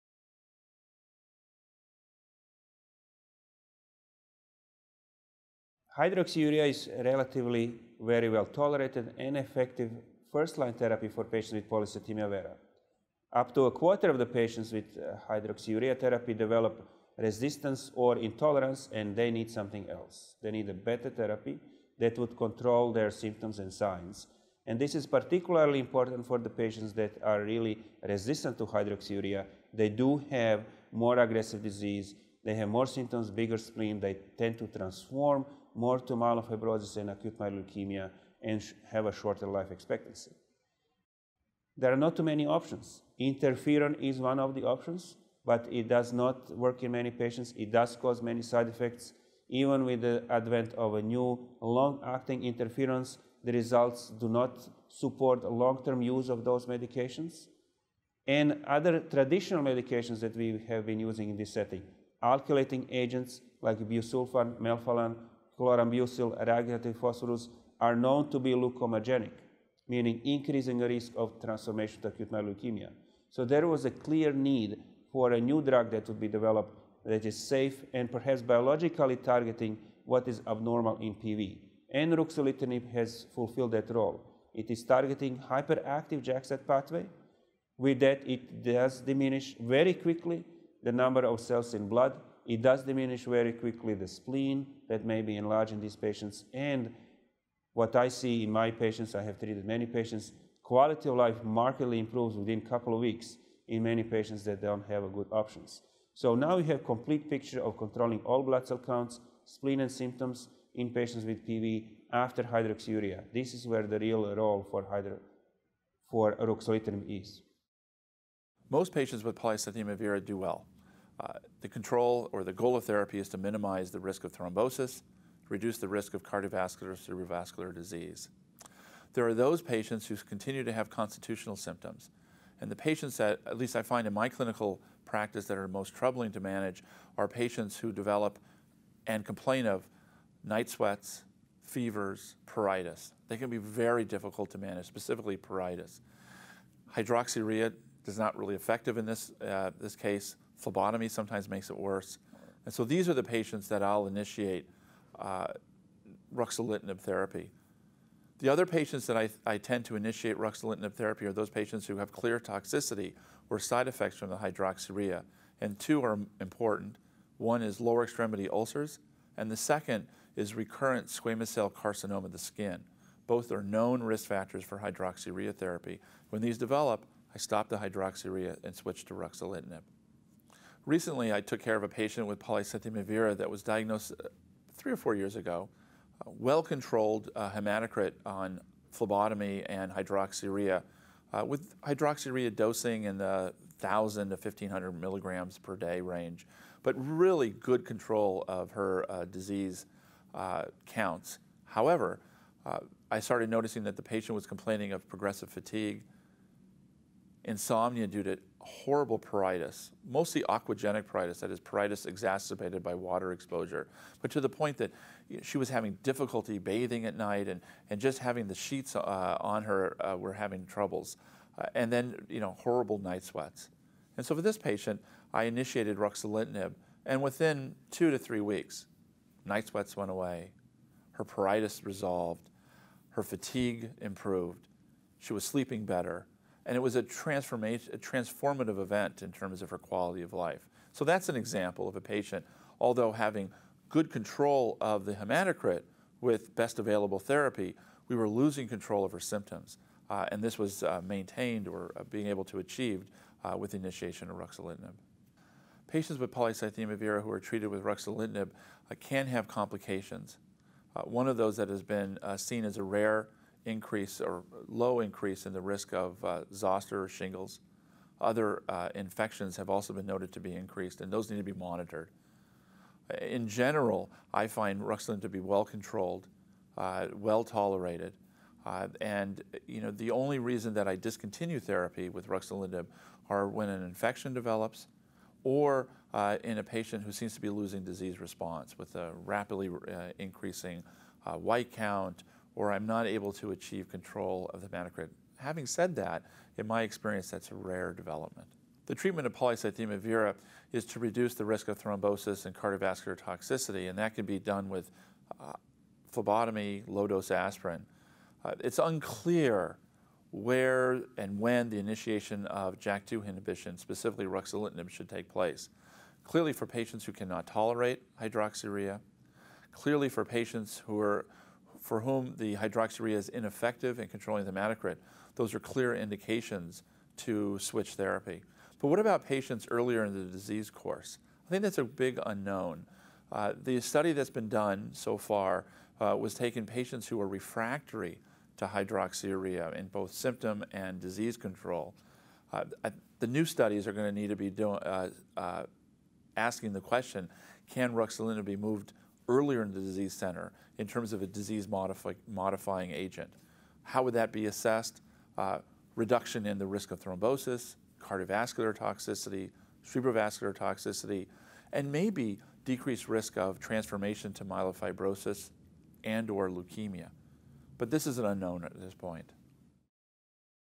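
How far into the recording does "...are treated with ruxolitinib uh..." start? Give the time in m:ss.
4:17.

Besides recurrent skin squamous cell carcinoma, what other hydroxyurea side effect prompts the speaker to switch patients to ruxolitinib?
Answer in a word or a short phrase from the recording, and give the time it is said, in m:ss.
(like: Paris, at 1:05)
Lower extremity ulcers, at 2:47.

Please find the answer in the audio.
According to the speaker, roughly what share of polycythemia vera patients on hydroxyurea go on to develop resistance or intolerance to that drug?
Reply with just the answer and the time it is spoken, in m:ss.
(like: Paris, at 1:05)
Up to a quarter, at 0:13.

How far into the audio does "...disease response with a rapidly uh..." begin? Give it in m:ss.
4:47.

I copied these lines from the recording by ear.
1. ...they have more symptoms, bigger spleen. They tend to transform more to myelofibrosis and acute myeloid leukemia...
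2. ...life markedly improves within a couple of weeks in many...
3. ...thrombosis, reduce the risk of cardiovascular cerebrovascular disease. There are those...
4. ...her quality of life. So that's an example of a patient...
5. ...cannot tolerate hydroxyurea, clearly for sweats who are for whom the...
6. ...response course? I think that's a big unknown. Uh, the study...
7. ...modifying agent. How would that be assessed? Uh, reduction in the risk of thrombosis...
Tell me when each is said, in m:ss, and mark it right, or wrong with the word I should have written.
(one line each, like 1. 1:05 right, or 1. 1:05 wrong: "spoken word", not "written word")
1. 0:32 right
2. 1:41 right
3. 2:04 right
4. 3:59 right
5. 5:17 wrong: "patients", not "sweats"
6. 5:30 wrong: "disease", not "response"
7. 5:52 right.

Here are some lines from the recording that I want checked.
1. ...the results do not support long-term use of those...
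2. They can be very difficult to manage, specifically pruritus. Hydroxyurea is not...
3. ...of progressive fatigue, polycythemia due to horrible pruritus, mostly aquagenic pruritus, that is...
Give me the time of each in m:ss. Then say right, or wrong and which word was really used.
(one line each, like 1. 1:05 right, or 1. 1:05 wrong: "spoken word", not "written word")
1. 0:53 right
2. 2:23 right
3. 3:24 wrong: "insomnia", not "polycythemia".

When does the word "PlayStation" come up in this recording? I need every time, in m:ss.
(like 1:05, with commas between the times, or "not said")
not said.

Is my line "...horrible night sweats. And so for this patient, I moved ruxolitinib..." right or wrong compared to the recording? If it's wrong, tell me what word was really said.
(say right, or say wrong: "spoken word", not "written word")
wrong: "initiated", not "moved".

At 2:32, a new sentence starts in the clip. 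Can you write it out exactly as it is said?
And so these are the patients that I'll initiate uh, ruxolitinib therapy.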